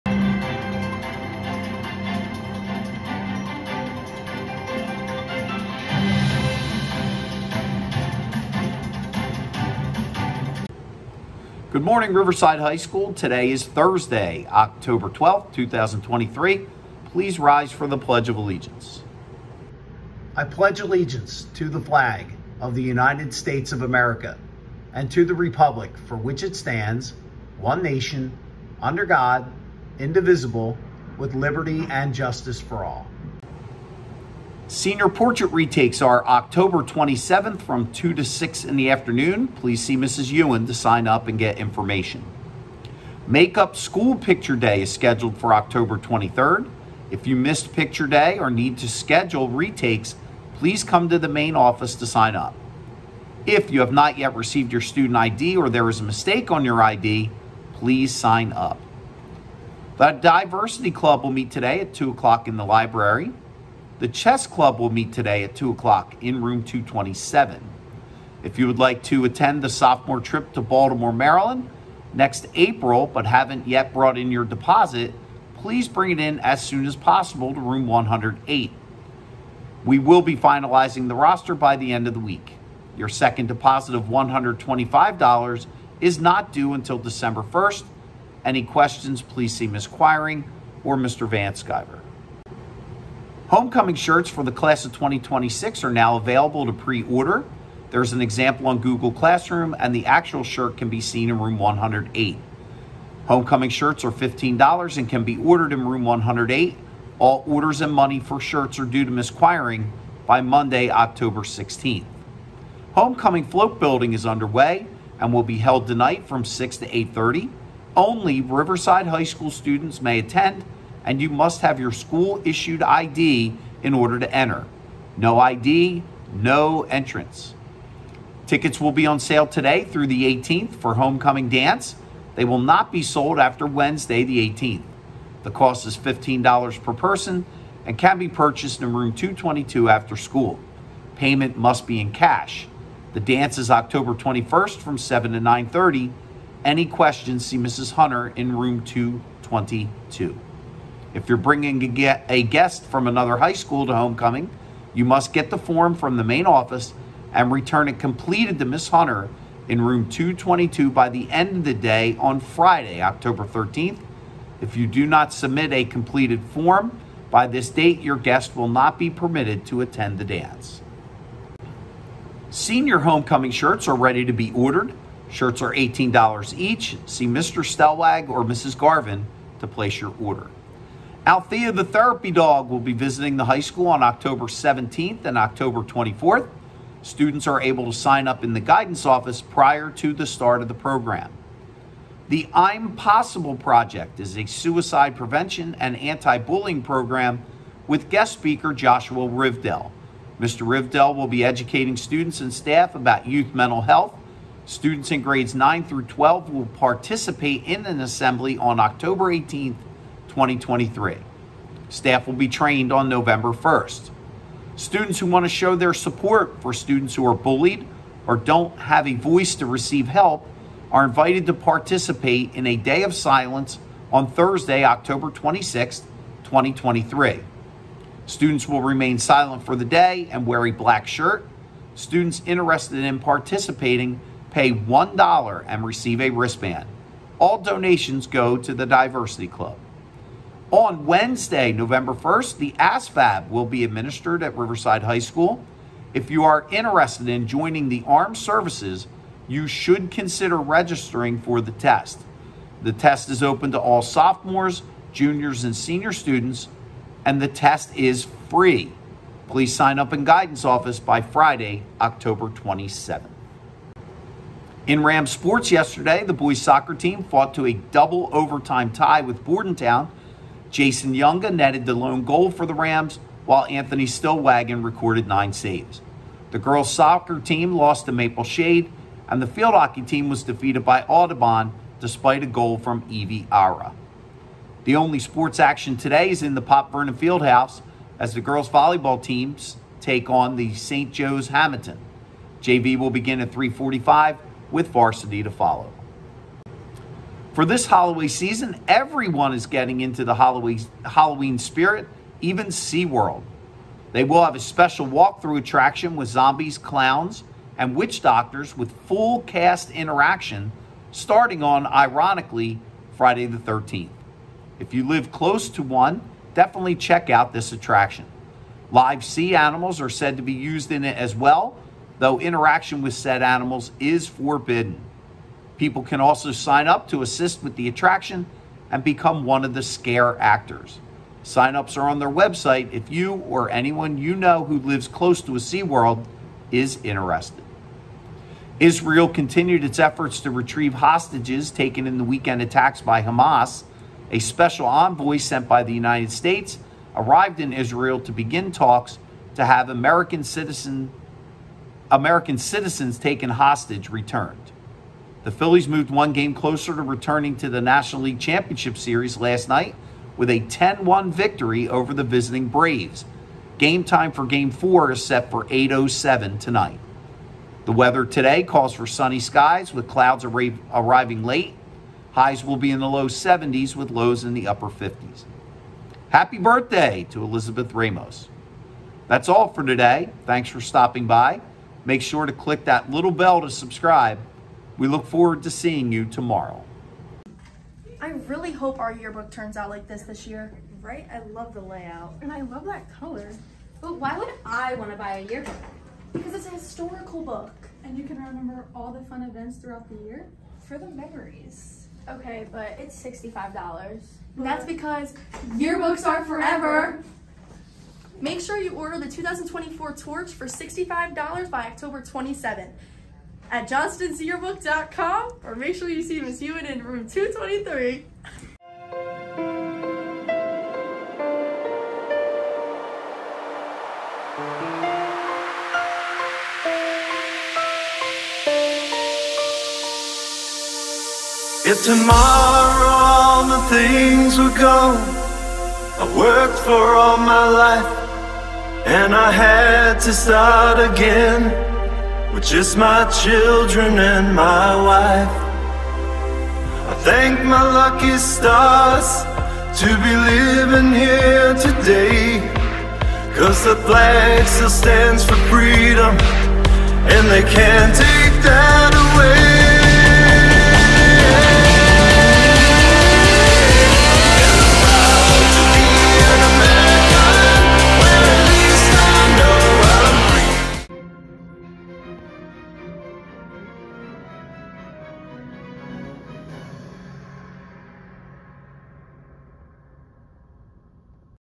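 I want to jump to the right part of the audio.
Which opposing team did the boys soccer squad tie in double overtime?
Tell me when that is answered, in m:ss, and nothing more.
4:29.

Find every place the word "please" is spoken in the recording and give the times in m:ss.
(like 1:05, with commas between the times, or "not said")
0:17, 0:39, 0:50, 0:57, 1:15, 1:29, 4:19.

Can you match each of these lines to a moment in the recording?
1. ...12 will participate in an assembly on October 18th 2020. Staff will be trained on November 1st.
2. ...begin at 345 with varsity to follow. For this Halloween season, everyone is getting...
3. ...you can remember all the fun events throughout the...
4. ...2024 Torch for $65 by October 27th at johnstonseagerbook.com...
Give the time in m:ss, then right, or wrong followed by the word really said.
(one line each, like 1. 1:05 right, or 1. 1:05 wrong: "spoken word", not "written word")
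1. 3:26 wrong: "2023", not "2020"
2. 4:53 right
3. 6:38 right
4. 6:49 right.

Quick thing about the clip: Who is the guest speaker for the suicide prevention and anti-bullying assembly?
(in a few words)
Joshua Rivedal.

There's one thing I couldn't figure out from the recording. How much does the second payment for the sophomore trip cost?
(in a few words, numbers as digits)
$125.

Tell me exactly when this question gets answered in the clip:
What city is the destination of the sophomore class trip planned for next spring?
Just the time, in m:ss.
1:10.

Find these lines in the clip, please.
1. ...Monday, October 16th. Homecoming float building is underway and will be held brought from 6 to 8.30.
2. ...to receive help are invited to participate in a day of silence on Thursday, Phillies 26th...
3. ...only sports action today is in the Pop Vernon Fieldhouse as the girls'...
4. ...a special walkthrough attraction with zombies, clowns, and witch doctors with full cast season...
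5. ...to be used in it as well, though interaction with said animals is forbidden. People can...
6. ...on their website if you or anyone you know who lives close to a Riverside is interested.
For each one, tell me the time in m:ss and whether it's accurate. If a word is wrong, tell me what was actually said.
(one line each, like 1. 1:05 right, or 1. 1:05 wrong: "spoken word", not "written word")
1. 1:50 wrong: "tonight", not "brought"
2. 3:39 wrong: "October", not "Phillies"
3. 4:44 right
4. 5:04 wrong: "interaction", not "season"
5. 5:20 right
6. 5:32 wrong: "SeaWorld", not "Riverside".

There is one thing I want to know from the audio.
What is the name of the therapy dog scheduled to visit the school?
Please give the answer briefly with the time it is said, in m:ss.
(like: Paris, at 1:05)
Althea, at 3:01.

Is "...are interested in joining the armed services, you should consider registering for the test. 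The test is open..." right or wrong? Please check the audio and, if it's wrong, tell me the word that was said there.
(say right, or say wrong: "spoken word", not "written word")
right.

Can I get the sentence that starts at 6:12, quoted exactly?
Highs will be in the low 70s with lows in the upper 50s.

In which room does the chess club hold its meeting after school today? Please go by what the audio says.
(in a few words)
227.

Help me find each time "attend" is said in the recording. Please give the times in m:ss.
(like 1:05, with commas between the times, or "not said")
1:09, 2:00, 2:49.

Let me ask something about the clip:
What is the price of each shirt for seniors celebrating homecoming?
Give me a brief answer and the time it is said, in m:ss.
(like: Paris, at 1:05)
$18, at 2:55.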